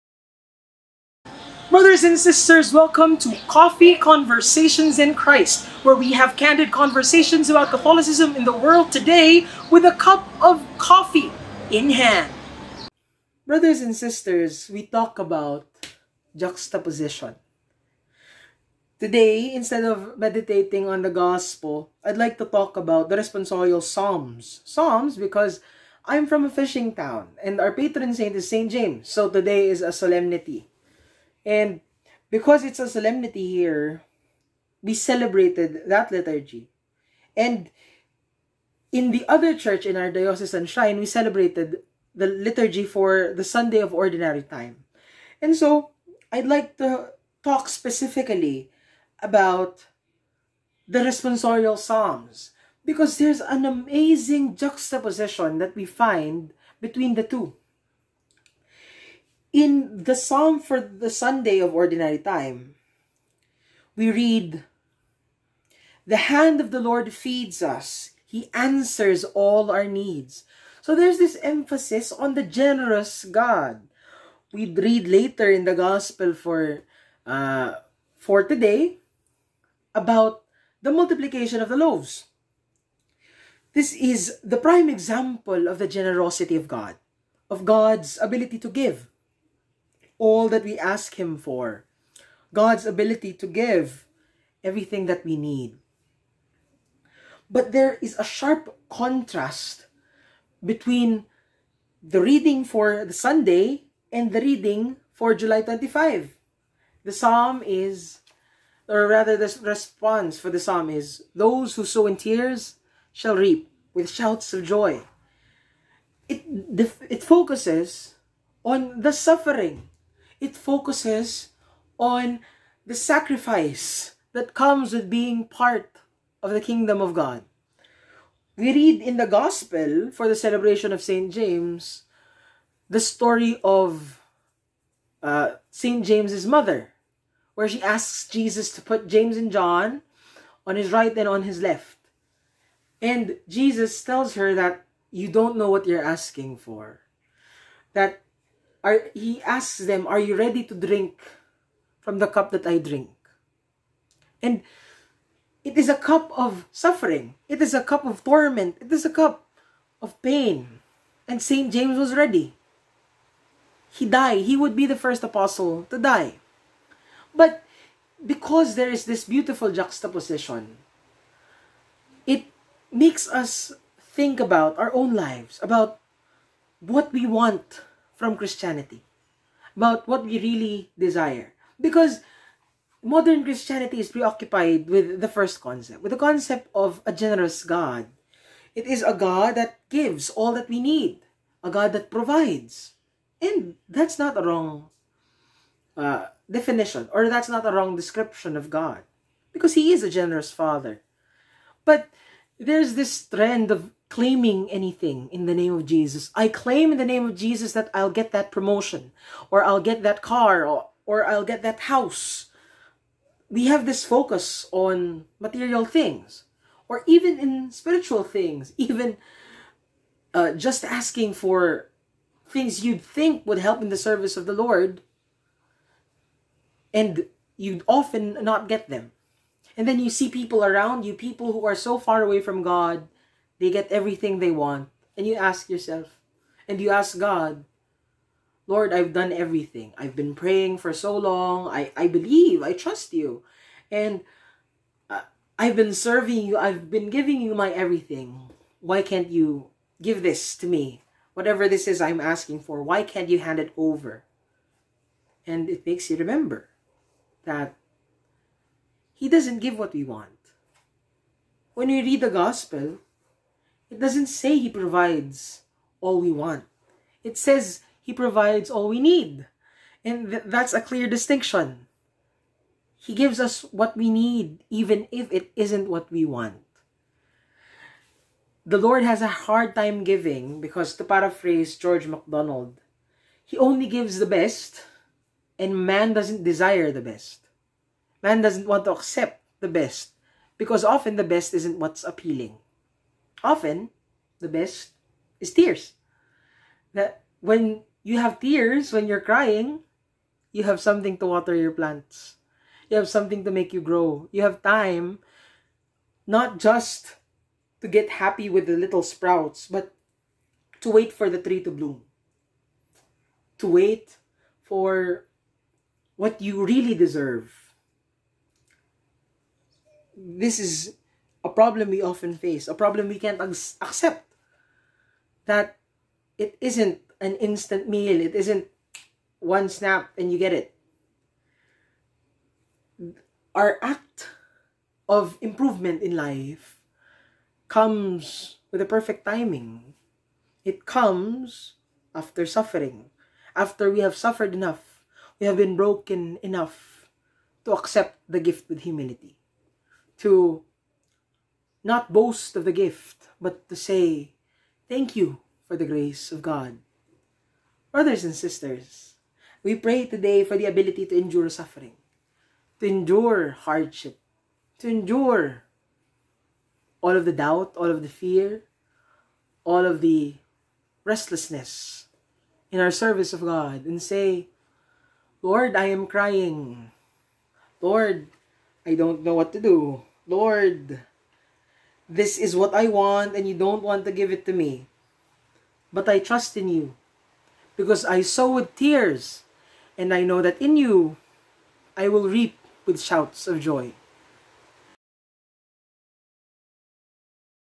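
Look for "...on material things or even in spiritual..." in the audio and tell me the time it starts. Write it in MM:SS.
03:34.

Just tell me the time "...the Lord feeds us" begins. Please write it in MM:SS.
01:06.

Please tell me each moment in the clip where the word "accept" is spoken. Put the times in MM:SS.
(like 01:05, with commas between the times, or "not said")
04:48, 05:23, 05:47.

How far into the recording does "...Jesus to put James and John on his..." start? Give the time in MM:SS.
02:18.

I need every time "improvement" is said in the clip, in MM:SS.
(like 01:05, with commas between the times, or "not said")
05:35.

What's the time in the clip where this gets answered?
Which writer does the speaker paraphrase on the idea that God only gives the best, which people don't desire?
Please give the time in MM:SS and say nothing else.
04:41.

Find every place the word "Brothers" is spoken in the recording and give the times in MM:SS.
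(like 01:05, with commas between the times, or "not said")
00:01, 00:13, 05:57.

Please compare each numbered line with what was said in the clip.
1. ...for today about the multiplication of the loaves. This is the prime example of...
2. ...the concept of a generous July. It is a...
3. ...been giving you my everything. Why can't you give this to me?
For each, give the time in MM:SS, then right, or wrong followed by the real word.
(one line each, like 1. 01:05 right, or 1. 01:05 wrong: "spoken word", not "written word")
1. 01:18 right
2. 03:06 wrong: "God", not "July"
3. 04:06 right.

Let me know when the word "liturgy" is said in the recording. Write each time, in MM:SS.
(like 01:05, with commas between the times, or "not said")
00:36, 00:42.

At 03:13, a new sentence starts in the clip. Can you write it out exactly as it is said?
And that's not a wrong uh, definition, or that's not a wrong description of God, because He is a generous Father.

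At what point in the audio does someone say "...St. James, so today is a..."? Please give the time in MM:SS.
00:28.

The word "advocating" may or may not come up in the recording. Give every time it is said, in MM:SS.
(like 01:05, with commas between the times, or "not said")
not said.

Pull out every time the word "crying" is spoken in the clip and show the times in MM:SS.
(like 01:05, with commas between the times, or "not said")
04:59, 06:16.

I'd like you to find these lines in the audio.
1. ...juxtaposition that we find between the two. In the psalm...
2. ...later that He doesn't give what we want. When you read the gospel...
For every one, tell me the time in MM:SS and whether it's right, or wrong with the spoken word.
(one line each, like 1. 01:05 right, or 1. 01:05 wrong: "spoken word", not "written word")
1. 00:54 right
2. 04:16 wrong: "remember", not "later".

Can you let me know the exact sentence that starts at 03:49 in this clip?
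And then you see people around you, people who are so far away from God, they get everything they want.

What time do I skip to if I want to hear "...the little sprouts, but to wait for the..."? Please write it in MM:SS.
05:08.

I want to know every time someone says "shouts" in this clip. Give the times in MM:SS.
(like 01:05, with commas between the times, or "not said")
01:54, 06:32.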